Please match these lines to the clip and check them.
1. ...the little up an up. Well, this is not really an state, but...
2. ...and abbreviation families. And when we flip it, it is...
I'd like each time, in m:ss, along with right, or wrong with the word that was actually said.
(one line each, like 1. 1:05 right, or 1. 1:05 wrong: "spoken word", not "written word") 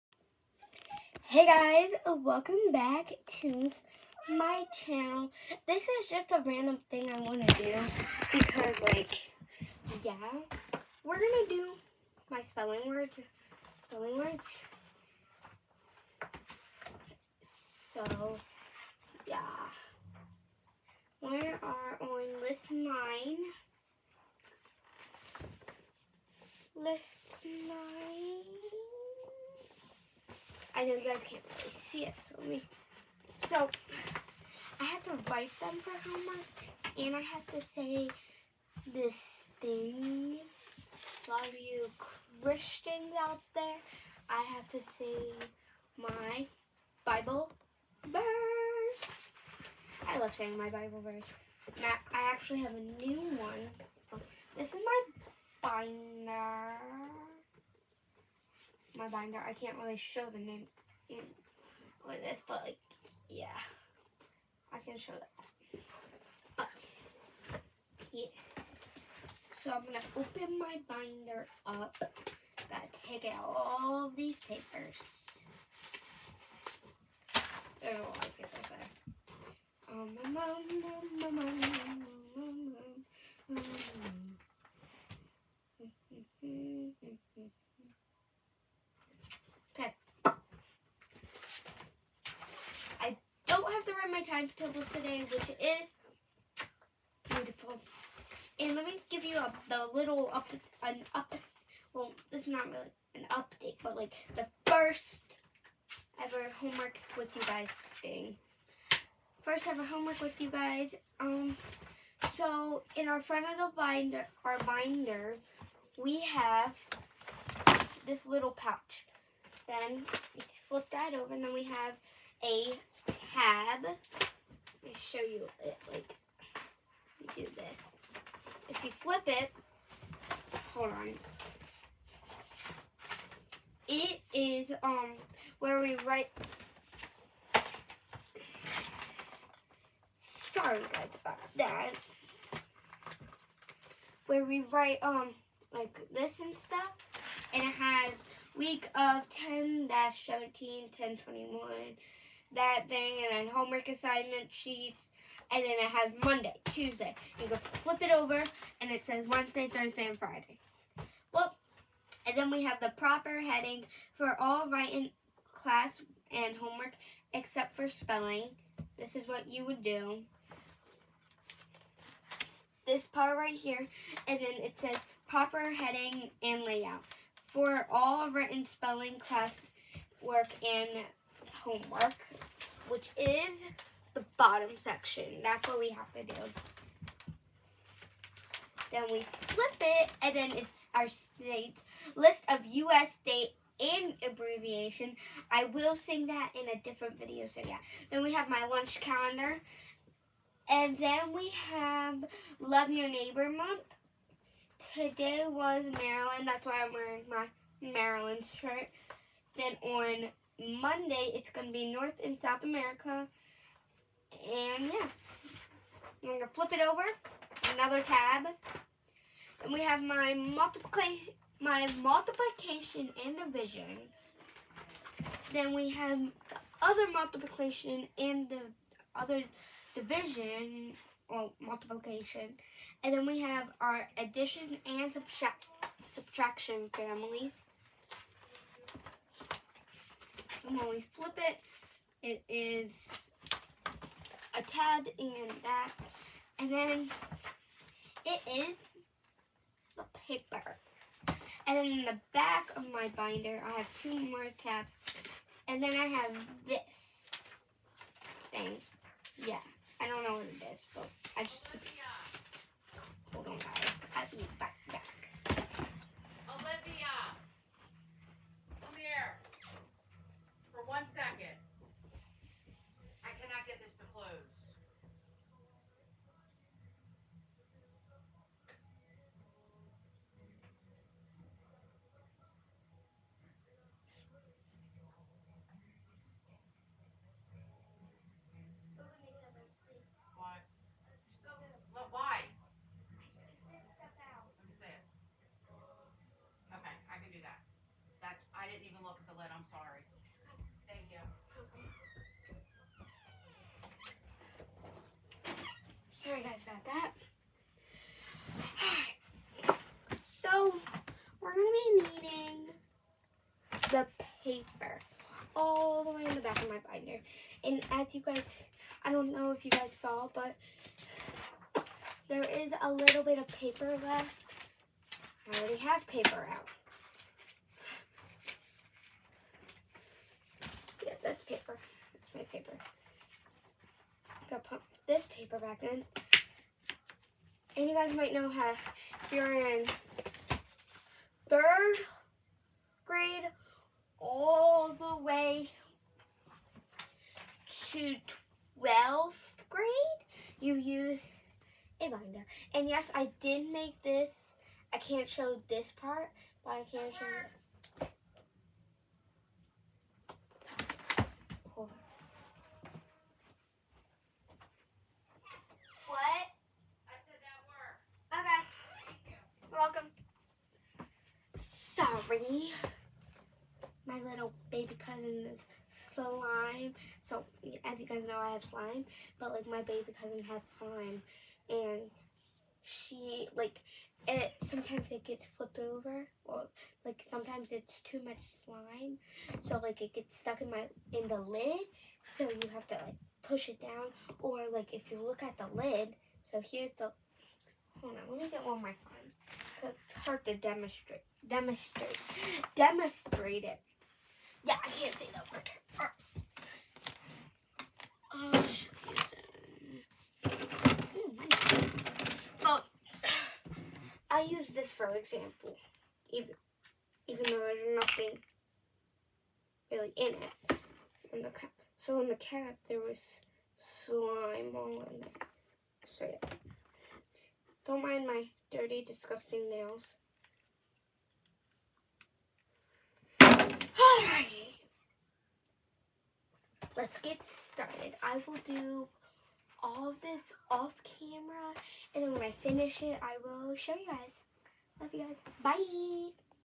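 1. 1:39 wrong: "update", not "state"
2. 3:54 wrong: "subtraction", not "abbreviation".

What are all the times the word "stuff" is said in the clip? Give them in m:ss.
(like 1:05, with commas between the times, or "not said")
2:26.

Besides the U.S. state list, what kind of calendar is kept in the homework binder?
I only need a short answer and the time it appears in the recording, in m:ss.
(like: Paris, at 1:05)
Lunch calendar, at 3:18.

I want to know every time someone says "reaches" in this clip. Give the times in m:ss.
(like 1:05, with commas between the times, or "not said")
not said.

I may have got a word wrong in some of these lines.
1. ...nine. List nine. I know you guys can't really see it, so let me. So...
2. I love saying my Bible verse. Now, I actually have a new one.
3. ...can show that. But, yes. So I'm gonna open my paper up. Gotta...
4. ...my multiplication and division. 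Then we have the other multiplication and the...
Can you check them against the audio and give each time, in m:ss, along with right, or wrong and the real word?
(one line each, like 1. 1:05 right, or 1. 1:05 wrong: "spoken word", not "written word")
1. 0:22 right
2. 0:50 right
3. 1:04 wrong: "binder", not "paper"
4. 3:41 right.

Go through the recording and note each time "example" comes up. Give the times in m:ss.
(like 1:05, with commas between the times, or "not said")
6:55.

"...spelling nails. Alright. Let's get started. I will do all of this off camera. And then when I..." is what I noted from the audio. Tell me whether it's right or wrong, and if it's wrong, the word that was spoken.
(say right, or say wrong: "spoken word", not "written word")
wrong: "disgusting", not "spelling".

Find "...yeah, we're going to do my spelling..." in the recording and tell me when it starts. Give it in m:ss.
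0:10.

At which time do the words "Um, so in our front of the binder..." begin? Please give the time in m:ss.
1:51.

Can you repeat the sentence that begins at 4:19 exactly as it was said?
Yeah, I don't know what it is, but I just...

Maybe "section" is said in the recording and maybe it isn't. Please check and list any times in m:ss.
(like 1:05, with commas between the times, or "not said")
3:04.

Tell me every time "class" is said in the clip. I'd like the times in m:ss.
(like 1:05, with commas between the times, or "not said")
2:45, 2:59.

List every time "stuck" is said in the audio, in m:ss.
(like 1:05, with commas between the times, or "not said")
6:30.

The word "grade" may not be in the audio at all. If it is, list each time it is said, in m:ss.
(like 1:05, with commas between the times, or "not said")
5:43, 5:49.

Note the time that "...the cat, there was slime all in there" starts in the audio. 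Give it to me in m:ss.
7:02.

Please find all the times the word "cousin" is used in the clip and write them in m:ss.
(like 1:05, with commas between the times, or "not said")
6:14, 6:20.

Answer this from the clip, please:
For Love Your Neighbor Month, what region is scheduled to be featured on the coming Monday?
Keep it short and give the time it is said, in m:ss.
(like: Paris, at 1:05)
North and South America, at 3:31.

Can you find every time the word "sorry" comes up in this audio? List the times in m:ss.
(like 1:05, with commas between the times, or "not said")
2:20, 4:59, 5:06.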